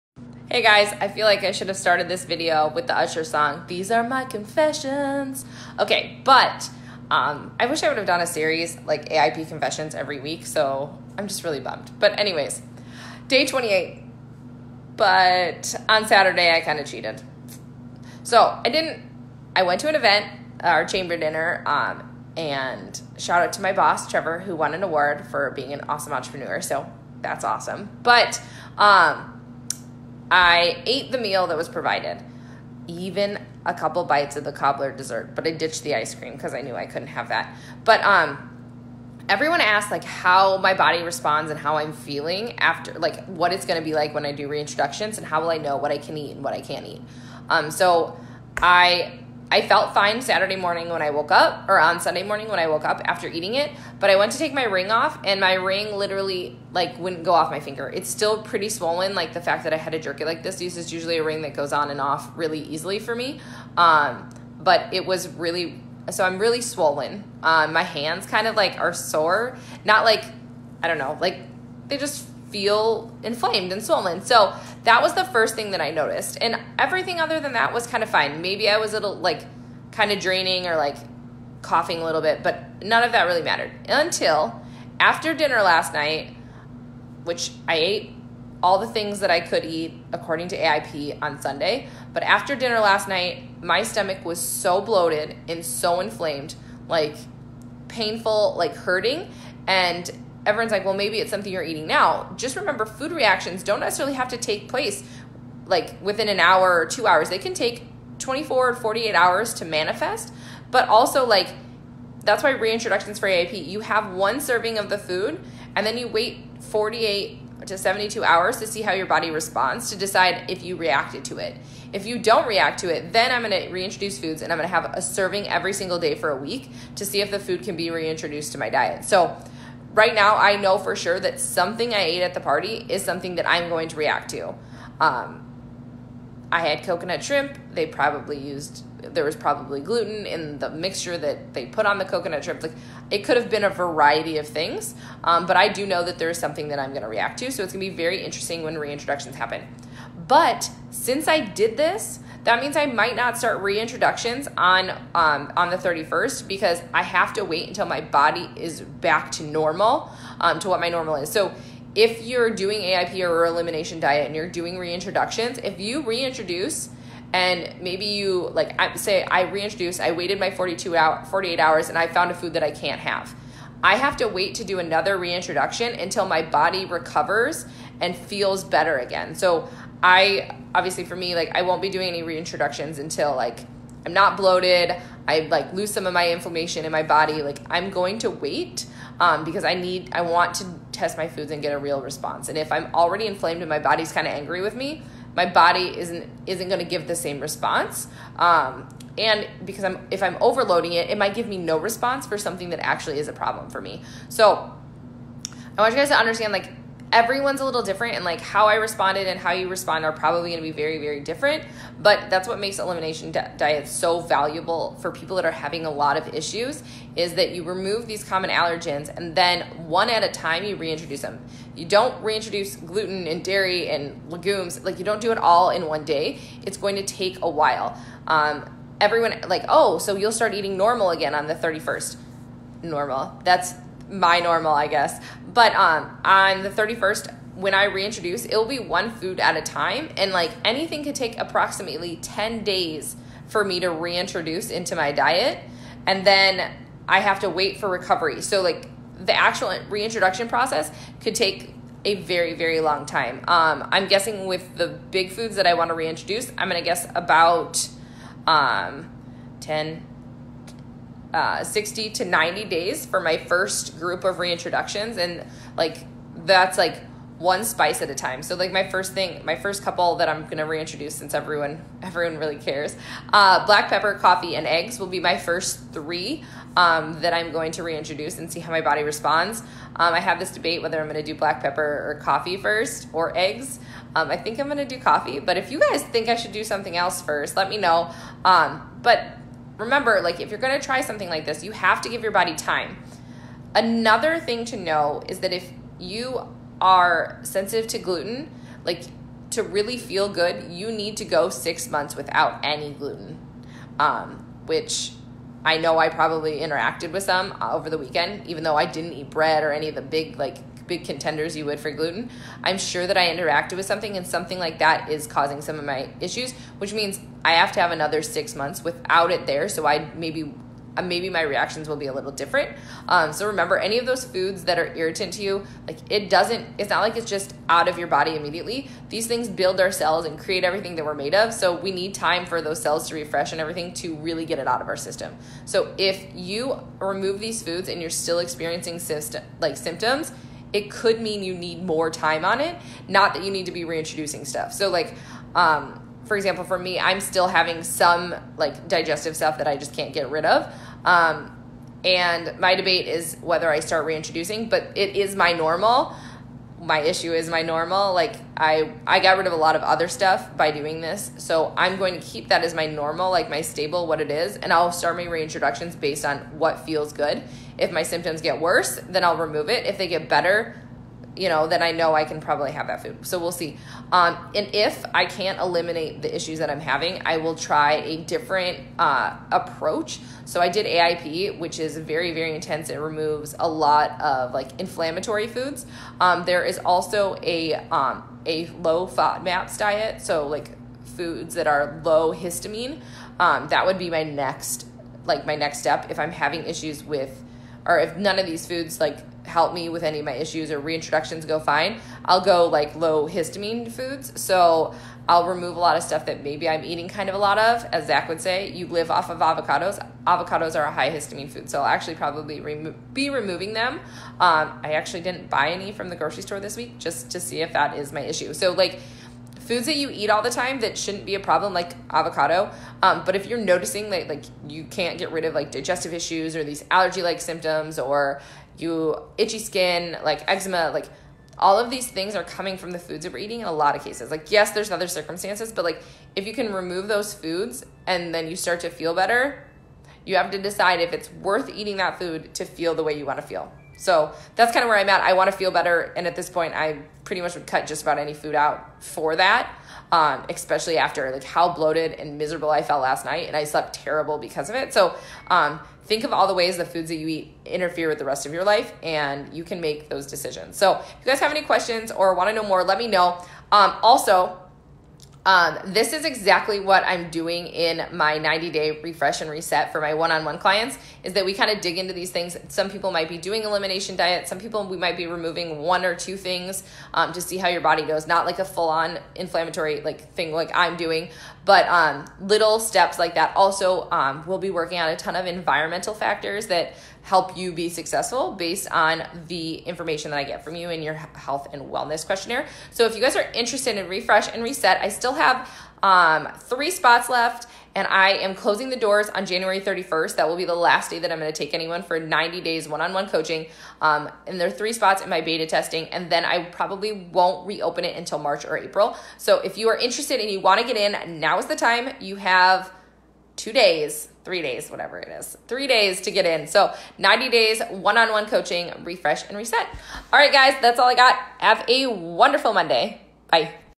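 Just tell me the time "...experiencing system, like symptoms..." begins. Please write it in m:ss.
5:38.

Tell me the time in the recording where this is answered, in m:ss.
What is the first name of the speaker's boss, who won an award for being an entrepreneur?
0:24.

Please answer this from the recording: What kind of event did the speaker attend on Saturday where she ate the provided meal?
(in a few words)
Chamber dinner.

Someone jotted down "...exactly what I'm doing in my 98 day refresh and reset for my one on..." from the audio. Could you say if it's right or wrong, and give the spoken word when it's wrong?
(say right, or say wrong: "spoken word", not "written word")
wrong: "90", not "98".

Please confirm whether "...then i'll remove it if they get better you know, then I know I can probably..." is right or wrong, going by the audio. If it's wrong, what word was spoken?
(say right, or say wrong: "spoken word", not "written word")
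right.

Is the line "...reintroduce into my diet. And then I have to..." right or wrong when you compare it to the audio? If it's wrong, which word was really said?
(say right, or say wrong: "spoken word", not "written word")
right.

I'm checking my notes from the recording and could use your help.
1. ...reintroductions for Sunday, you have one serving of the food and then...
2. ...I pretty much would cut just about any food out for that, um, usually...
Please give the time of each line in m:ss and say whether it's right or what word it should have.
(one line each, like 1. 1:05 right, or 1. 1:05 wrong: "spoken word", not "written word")
1. 1:52 wrong: "AIP", not "Sunday"
2. 7:26 wrong: "especially", not "usually".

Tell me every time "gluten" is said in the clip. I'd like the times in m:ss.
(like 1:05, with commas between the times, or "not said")
2:19, 3:42, 4:57, 5:02, 5:11.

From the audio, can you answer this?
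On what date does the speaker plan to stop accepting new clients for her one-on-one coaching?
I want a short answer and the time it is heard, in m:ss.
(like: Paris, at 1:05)
January 31st, at 8:19.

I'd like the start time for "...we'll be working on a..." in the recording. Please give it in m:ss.
8:04.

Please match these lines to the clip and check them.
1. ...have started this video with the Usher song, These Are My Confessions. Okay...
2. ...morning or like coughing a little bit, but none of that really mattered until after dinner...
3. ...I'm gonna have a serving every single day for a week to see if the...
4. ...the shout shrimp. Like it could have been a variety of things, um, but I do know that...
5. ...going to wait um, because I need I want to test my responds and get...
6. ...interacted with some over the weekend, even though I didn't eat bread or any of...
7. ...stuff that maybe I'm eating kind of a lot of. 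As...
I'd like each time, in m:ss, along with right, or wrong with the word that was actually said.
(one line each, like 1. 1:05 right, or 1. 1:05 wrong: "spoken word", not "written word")
1. 0:01 right
2. 1:20 wrong: "draining", not "morning"
3. 2:04 right
4. 2:21 wrong: "coconut", not "shout"
5. 3:07 wrong: "foods", not "responds"
6. 5:06 right
7. 6:46 right.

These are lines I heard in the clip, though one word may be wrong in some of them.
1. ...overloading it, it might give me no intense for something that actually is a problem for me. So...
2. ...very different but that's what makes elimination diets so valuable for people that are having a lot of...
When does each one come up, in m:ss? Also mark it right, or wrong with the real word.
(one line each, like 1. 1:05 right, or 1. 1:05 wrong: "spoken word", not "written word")
1. 3:20 wrong: "response", not "intense"
2. 3:30 right.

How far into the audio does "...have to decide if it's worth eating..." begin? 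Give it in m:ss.
7:20.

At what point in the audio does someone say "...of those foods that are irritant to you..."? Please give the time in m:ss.
5:23.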